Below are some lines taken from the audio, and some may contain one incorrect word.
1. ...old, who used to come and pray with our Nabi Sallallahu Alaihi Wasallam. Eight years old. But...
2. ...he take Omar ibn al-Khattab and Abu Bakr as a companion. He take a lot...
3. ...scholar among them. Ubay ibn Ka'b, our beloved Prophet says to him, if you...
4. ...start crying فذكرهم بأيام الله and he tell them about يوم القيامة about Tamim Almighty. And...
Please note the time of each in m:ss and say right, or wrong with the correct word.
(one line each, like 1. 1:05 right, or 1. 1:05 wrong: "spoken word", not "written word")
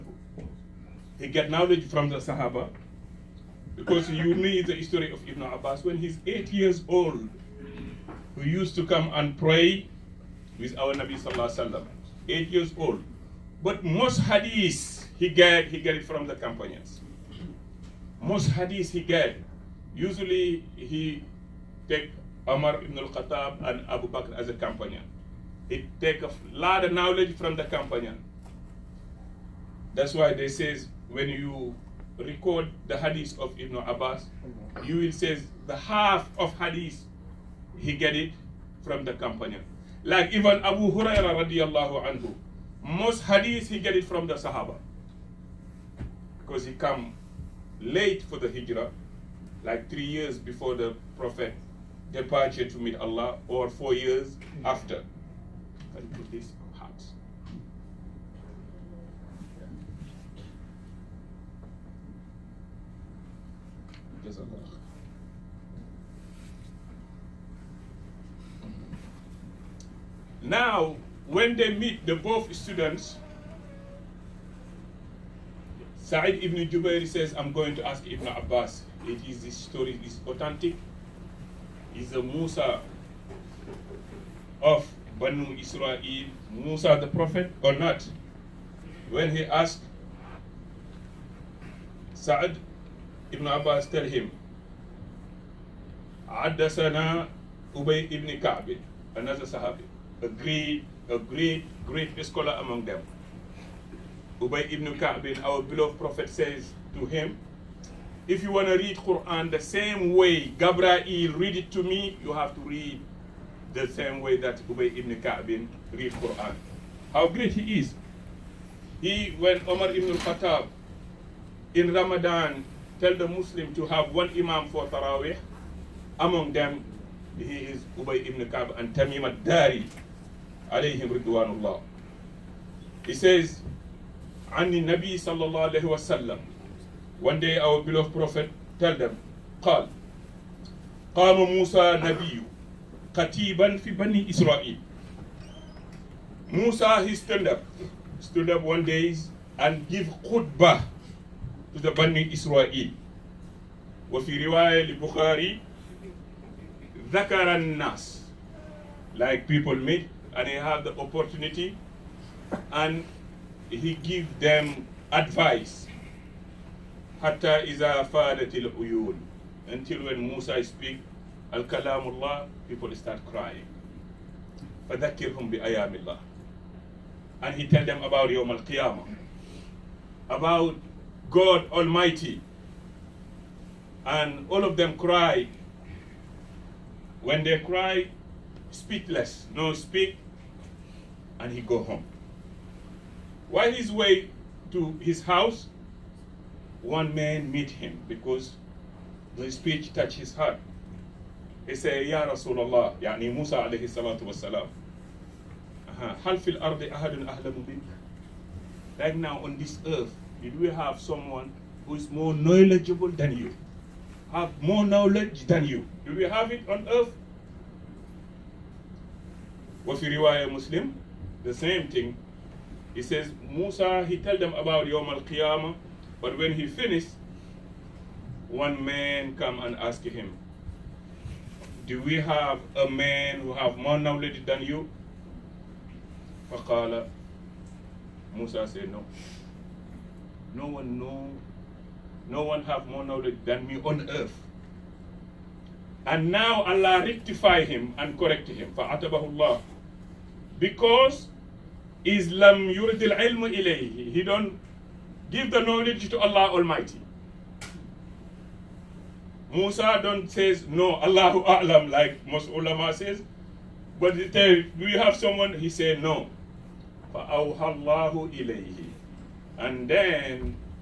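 1. 0:06 right
2. 0:20 right
3. 1:42 right
4. 2:52 wrong: "God", not "Tamim".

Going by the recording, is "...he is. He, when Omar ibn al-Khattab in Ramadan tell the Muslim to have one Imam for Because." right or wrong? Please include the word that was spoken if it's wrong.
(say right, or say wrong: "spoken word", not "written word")
wrong: "Taraweeh", not "Because".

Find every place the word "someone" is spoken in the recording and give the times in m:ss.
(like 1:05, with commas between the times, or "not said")
3:30, 4:25.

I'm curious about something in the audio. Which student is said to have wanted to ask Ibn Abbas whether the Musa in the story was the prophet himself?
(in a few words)
Sa'id ibn Jubair.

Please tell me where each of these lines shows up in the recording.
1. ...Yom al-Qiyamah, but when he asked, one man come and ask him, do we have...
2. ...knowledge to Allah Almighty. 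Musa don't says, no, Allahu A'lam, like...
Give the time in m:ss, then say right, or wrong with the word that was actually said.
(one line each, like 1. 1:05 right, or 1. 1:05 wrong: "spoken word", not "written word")
1. 3:44 wrong: "finished", not "asked"
2. 4:15 right.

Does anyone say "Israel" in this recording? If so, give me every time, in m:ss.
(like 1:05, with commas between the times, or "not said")
1:25, 2:32.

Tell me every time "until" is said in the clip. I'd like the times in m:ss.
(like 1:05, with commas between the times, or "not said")
2:49.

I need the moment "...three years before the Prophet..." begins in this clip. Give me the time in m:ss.
0:49.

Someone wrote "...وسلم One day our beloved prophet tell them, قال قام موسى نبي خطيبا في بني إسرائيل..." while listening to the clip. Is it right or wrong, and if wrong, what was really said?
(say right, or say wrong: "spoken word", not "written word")
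right.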